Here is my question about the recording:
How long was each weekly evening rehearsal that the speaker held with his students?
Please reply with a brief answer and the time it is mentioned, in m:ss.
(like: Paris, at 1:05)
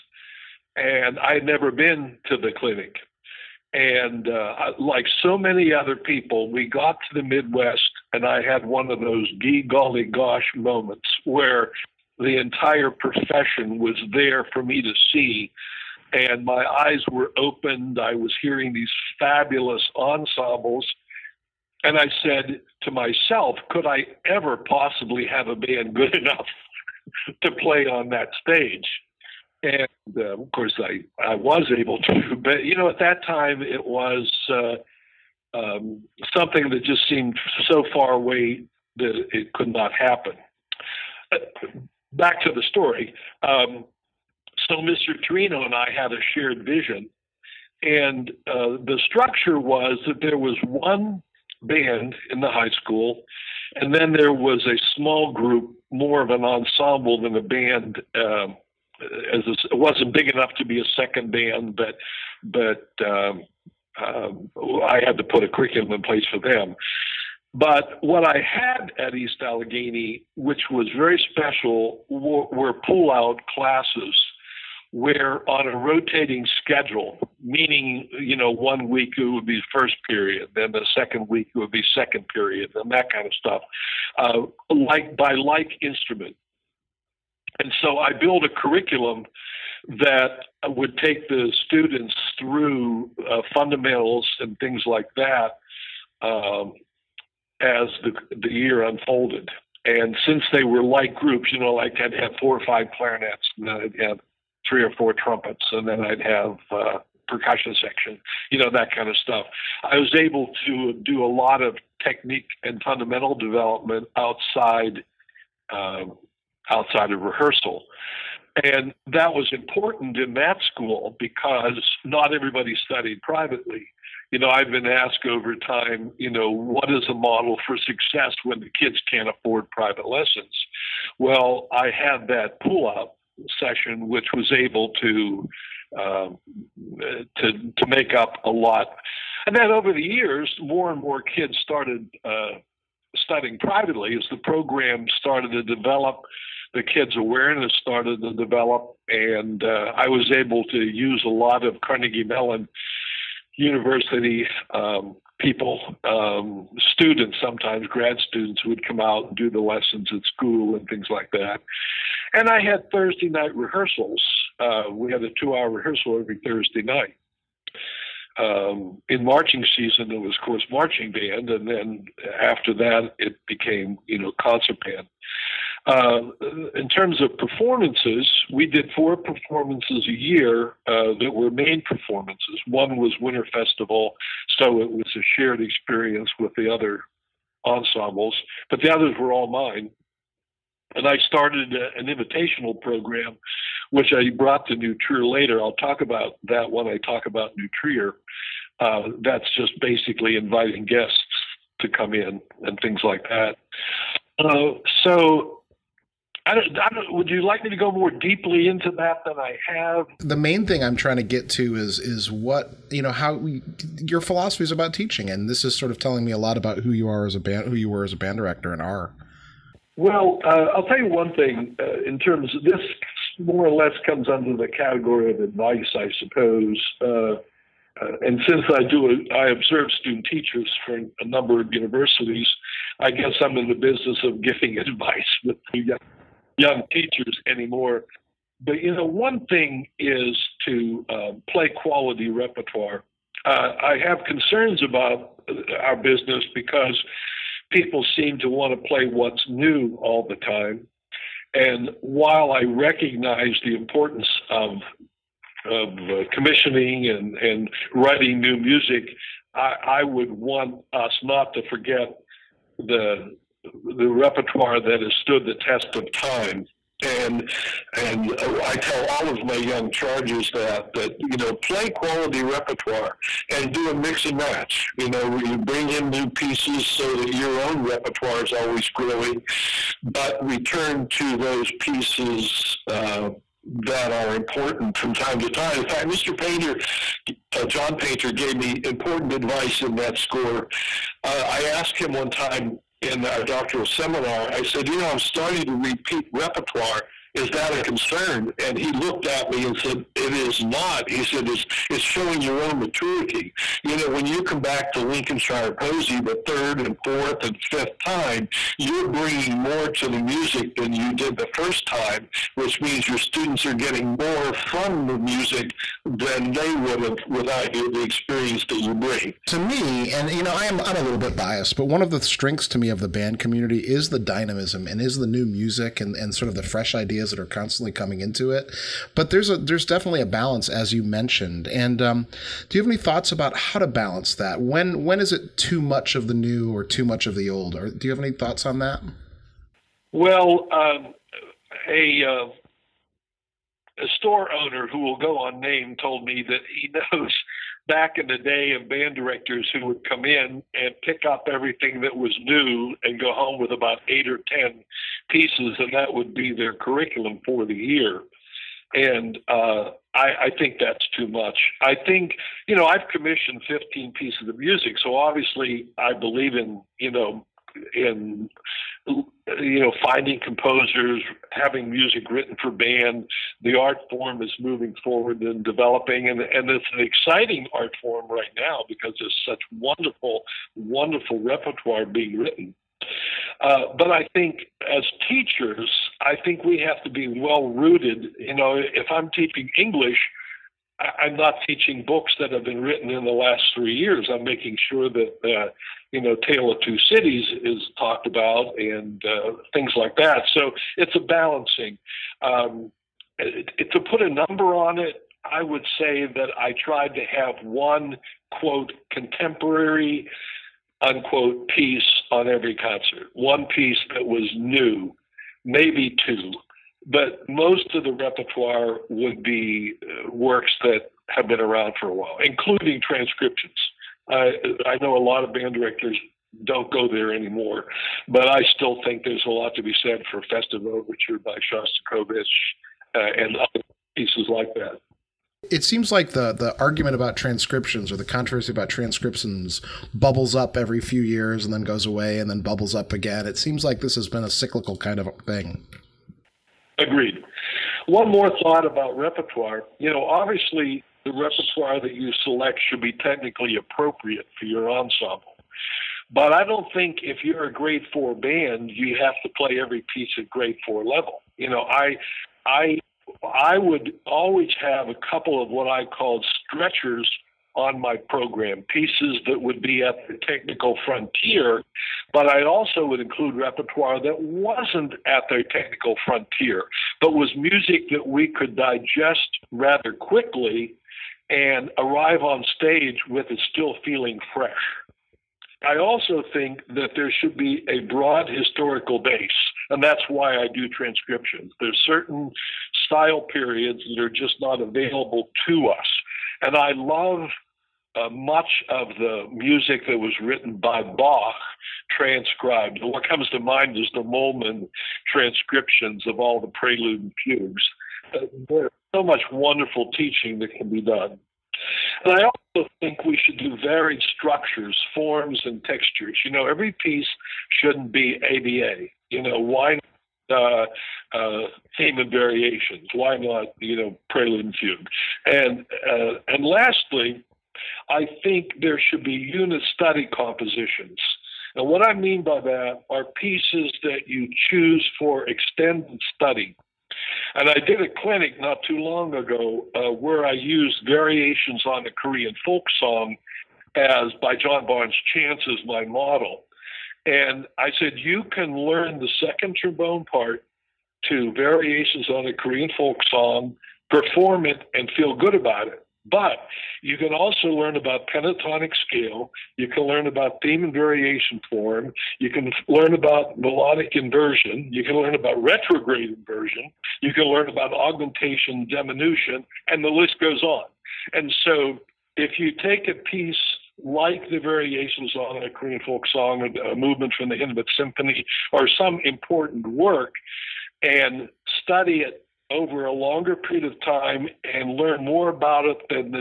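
2 hours, at 2:45.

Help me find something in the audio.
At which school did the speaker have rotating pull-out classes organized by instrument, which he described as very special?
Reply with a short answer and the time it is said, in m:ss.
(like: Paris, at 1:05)
East Allegheny, at 1:09.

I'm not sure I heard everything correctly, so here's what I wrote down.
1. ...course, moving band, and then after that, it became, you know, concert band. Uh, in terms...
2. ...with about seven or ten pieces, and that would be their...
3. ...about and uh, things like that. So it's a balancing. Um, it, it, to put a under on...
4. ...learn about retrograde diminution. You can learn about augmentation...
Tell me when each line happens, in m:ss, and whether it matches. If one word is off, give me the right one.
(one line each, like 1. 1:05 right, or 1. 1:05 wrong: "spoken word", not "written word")
1. 2:50 wrong: "marching", not "moving"
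2. 5:53 wrong: "eight", not "seven"
3. 6:38 wrong: "number", not "under"
4. 9:25 wrong: "inversion", not "diminution".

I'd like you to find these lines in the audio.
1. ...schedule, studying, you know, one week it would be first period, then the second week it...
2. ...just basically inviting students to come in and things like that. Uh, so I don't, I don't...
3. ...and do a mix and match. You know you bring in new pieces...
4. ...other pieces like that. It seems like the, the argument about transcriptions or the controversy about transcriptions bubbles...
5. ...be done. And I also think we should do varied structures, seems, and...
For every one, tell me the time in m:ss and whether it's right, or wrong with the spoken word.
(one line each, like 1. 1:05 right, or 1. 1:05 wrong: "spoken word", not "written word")
1. 1:16 wrong: "meaning", not "studying"
2. 3:19 wrong: "guests", not "students"
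3. 4:33 right
4. 7:13 right
5. 8:30 wrong: "forms", not "seems".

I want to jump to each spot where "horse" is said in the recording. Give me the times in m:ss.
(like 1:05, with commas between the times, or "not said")
not said.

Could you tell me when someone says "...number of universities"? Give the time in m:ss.
3:51.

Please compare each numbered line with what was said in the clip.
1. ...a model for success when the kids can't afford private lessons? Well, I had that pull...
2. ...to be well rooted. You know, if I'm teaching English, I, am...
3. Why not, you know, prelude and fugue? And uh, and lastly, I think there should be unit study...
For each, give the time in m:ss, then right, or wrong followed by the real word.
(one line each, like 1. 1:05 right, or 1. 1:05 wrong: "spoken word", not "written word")
1. 2:07 right
2. 6:27 right
3. 8:43 right.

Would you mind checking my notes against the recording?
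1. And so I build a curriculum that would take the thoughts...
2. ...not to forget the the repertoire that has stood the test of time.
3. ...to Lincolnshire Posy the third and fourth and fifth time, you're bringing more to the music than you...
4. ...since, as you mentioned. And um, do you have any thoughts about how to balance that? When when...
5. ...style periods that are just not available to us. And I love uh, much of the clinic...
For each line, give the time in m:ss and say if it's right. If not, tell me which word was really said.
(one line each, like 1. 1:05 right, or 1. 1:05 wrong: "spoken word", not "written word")
1. 1:27 wrong: "students", not "thoughts"
2. 4:21 right
3. 5:04 right
4. 5:30 wrong: "balance", not "since"
5. 8:13 wrong: "music", not "clinic".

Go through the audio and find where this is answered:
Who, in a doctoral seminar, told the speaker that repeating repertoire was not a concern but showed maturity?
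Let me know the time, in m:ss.
4:47.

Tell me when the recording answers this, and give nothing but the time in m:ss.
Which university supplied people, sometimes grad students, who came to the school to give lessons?
2:31.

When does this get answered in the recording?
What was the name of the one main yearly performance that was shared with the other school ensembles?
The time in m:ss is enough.
3:03.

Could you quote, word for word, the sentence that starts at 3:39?
Well, uh, I'll tell you one thing.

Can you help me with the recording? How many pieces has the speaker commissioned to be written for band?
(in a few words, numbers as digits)
15.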